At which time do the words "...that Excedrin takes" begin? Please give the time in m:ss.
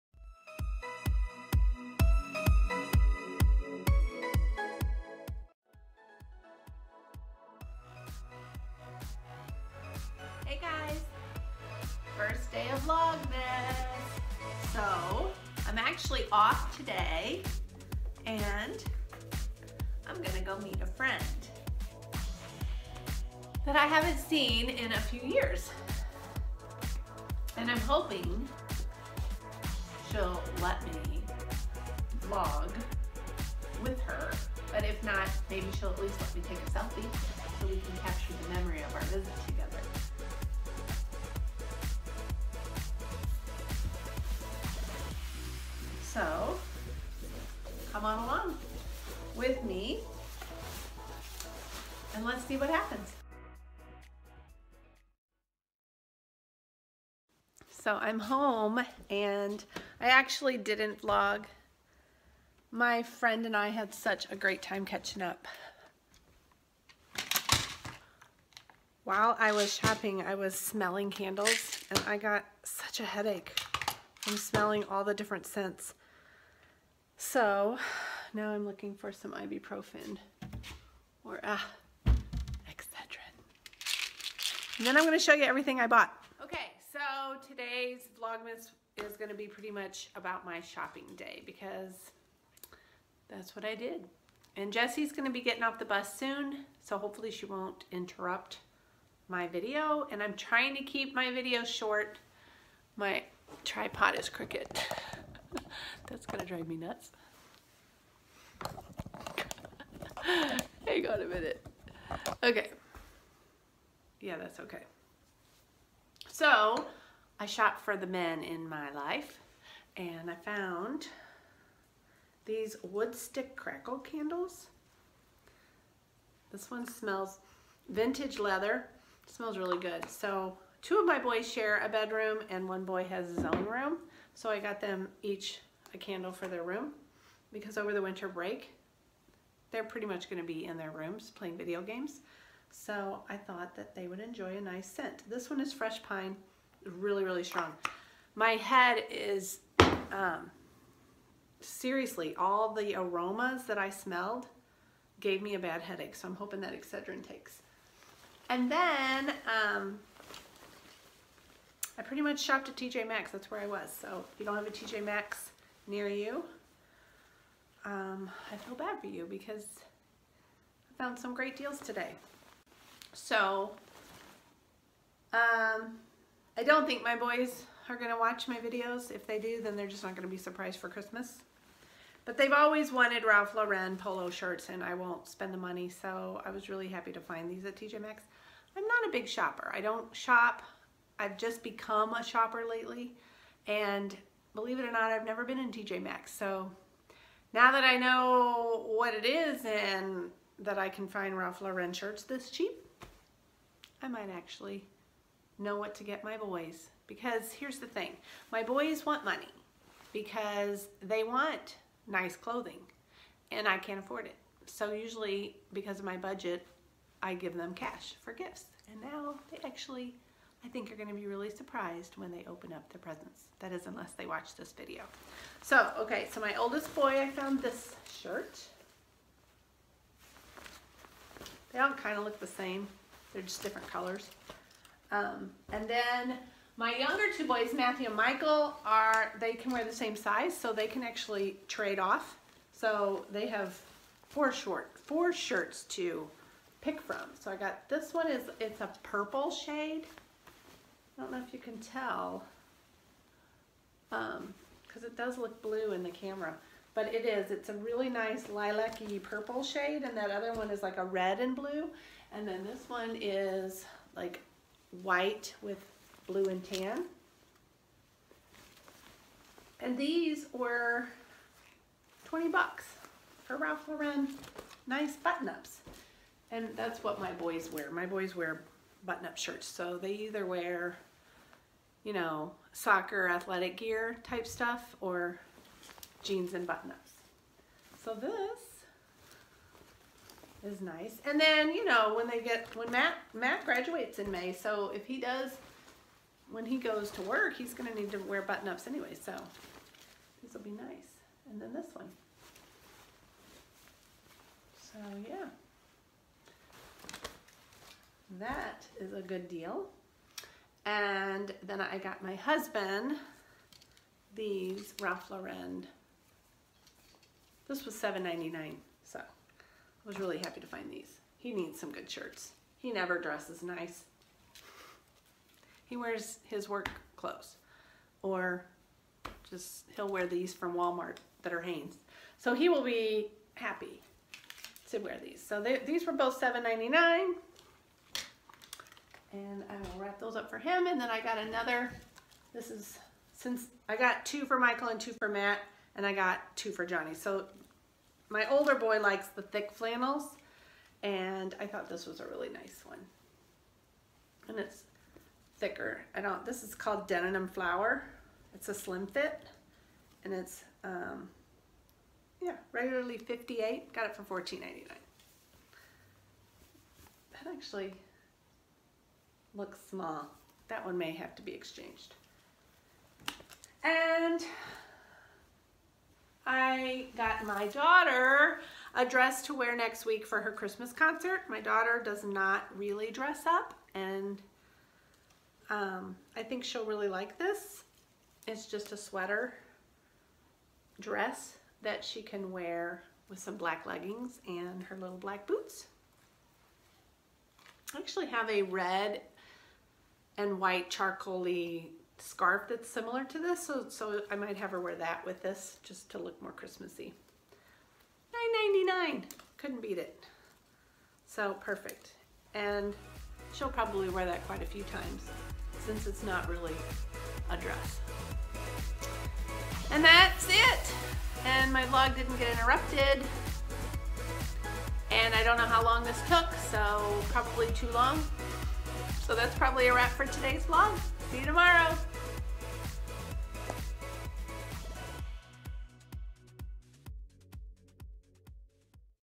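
2:36.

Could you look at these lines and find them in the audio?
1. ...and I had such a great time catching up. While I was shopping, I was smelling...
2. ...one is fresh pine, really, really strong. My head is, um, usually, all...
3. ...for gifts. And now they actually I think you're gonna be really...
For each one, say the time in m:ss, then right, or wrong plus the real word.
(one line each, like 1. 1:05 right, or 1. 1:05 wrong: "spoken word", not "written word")
1. 1:03 right
2. 2:25 wrong: "seriously", not "usually"
3. 3:38 right.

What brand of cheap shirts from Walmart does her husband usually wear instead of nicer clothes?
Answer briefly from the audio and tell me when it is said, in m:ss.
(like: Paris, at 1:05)
Hanes, at 5:31.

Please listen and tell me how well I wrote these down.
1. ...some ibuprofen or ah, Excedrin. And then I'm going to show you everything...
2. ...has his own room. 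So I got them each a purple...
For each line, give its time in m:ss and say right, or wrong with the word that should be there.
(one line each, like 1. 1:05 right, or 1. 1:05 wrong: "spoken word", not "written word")
1. 1:19 right
2. 2:13 wrong: "candle", not "purple".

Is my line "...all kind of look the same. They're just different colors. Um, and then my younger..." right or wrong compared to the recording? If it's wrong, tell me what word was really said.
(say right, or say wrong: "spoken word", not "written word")
right.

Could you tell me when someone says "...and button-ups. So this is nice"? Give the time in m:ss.
4:46.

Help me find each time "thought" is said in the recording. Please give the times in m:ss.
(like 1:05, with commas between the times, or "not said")
2:23, 5:51.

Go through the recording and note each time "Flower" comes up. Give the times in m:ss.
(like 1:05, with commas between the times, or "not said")
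5:57.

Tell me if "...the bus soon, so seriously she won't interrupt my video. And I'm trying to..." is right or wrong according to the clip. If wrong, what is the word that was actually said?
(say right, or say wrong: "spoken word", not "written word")
wrong: "hopefully", not "seriously".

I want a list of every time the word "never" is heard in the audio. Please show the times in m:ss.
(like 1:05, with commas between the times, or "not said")
3:15, 5:22.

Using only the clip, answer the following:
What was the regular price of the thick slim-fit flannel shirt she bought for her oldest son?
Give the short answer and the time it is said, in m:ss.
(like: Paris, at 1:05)
$58, at 6:03.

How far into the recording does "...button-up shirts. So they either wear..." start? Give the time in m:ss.
4:39.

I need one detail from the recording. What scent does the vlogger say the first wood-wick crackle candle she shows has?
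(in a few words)
vintage leather.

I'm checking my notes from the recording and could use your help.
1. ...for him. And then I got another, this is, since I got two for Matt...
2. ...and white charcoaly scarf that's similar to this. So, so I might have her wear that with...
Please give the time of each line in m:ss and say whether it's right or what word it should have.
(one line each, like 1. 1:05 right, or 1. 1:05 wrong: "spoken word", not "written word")
1. 5:40 wrong: "Michael", not "Matt"
2. 6:40 right.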